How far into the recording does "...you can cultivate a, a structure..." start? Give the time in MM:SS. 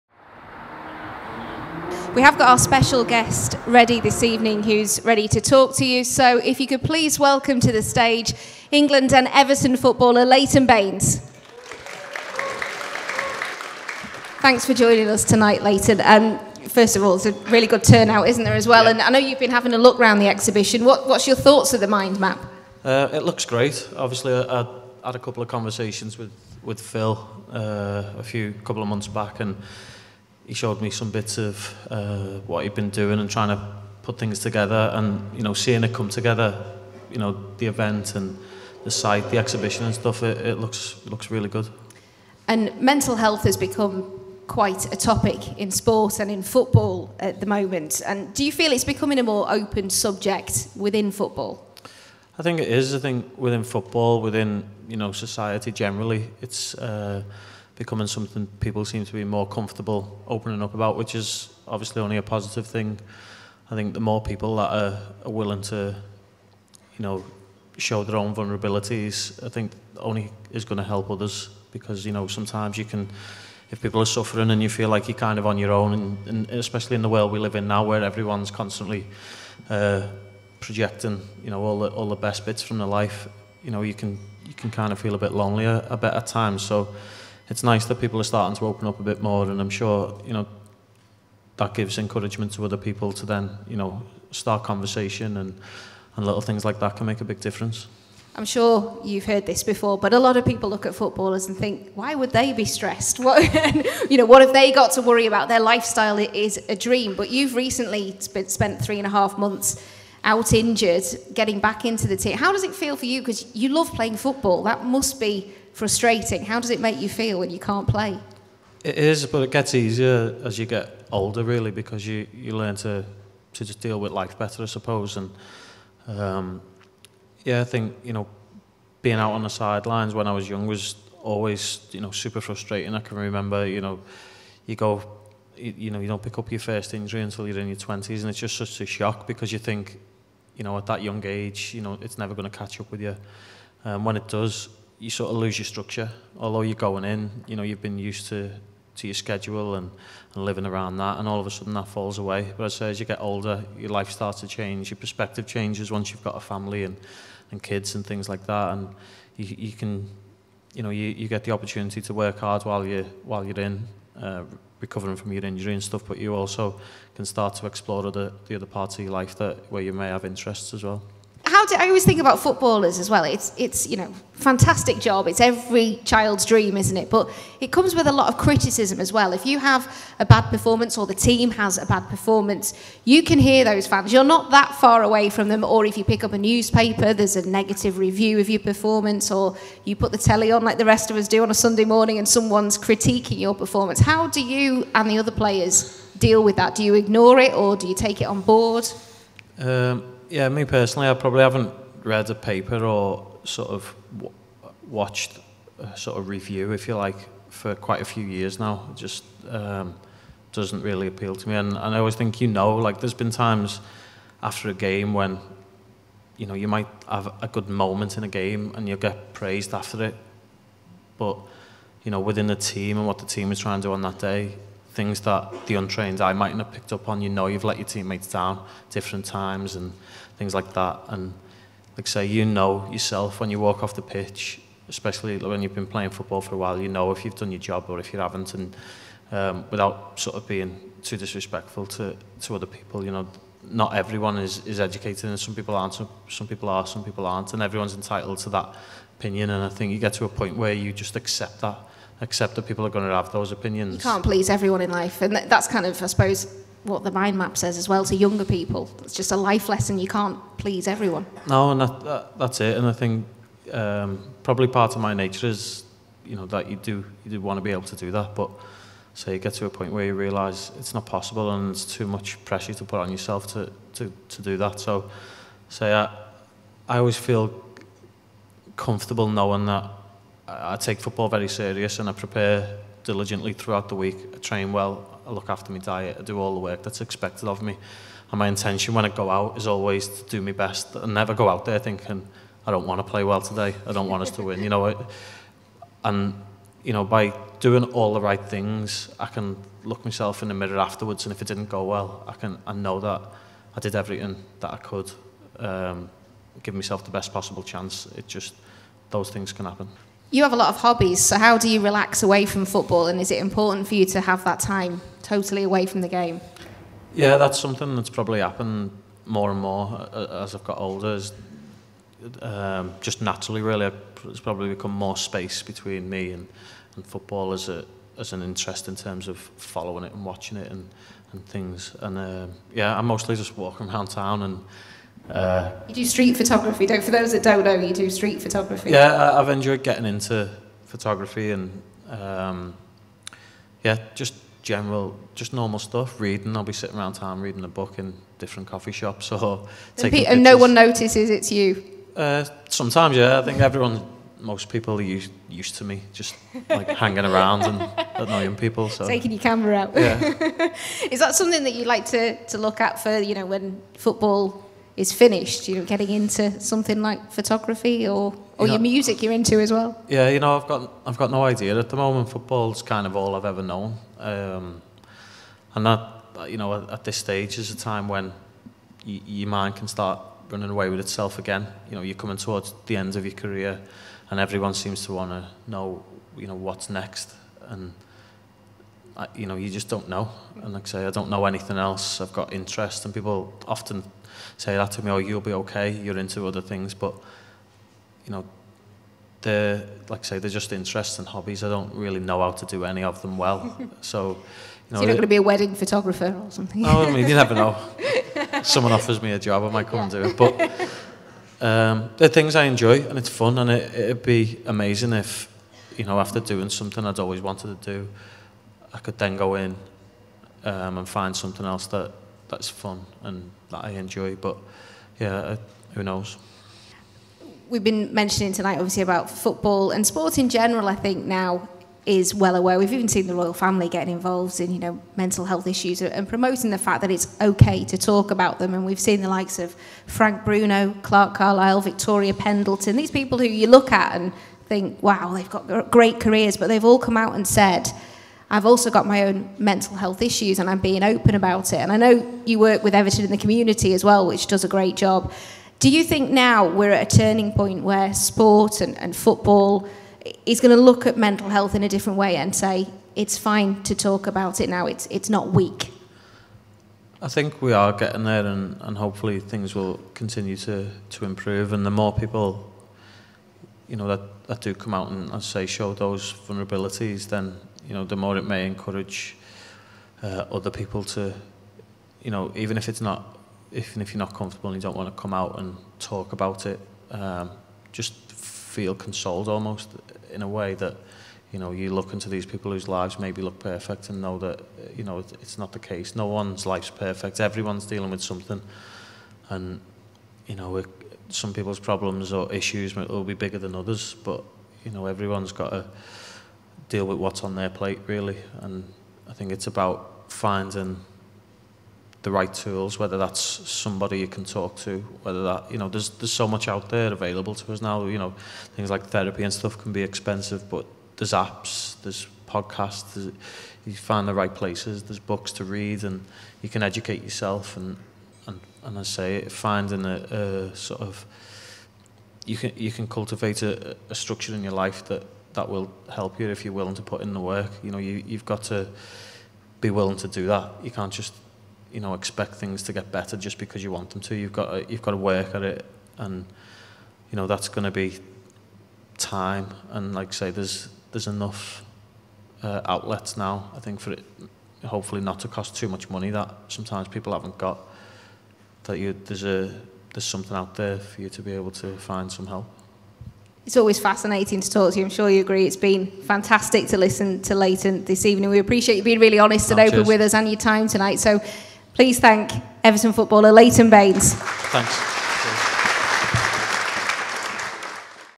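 08:52.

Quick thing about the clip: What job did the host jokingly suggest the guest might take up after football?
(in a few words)
wedding photographer.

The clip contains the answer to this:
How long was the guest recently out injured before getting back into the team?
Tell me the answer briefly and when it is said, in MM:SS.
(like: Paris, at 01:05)
three and a half months, at 01:48.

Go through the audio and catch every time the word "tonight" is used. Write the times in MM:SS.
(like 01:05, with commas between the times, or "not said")
00:15, 07:08, 09:30.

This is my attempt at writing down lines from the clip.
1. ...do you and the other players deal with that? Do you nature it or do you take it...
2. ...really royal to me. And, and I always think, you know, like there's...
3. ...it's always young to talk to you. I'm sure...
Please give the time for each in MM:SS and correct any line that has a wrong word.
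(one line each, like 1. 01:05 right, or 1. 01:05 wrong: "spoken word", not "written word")
1. 03:14 wrong: "ignore", not "nature"
2. 03:30 wrong: "appeal", not "royal"
3. 09:23 wrong: "fascinating", not "young".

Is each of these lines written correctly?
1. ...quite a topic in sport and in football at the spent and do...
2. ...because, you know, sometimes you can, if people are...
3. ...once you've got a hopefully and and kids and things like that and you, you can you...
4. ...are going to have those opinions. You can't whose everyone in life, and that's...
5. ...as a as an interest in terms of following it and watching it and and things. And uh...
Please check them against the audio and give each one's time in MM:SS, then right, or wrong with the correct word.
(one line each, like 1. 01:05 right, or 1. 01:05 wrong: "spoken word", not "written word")
1. 00:44 wrong: "moment", not "spent"
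2. 01:11 right
3. 02:35 wrong: "family", not "hopefully"
4. 04:12 wrong: "please", not "whose"
5. 05:27 right.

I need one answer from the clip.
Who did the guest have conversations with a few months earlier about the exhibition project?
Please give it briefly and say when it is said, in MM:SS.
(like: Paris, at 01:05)
Phil, at 00:26.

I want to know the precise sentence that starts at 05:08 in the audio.
It just, those things can happen.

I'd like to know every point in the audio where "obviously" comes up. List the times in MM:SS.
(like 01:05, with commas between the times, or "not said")
00:23, 01:01, 07:08.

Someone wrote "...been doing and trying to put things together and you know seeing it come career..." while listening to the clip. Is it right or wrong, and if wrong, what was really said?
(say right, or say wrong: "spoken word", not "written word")
wrong: "together", not "career".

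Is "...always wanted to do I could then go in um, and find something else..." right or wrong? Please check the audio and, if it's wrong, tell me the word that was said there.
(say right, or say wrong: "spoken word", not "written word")
right.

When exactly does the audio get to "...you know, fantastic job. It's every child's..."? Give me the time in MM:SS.
02:53.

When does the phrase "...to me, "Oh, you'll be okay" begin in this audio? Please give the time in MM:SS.
06:34.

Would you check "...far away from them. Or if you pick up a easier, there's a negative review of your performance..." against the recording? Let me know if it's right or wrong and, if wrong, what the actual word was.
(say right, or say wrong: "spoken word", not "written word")
wrong: "newspaper", not "easier".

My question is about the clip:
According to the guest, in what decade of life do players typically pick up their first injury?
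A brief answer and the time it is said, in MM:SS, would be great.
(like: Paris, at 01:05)
20s, at 02:17.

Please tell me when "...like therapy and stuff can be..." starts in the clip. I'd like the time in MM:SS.
08:38.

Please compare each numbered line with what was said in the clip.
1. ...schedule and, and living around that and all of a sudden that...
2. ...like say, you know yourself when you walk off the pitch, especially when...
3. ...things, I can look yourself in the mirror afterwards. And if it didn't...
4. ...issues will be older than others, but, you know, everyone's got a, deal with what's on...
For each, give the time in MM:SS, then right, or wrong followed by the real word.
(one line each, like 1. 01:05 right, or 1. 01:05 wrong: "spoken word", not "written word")
1. 02:29 right
2. 03:51 right
3. 04:58 wrong: "myself", not "yourself"
4. 08:22 wrong: "bigger", not "older".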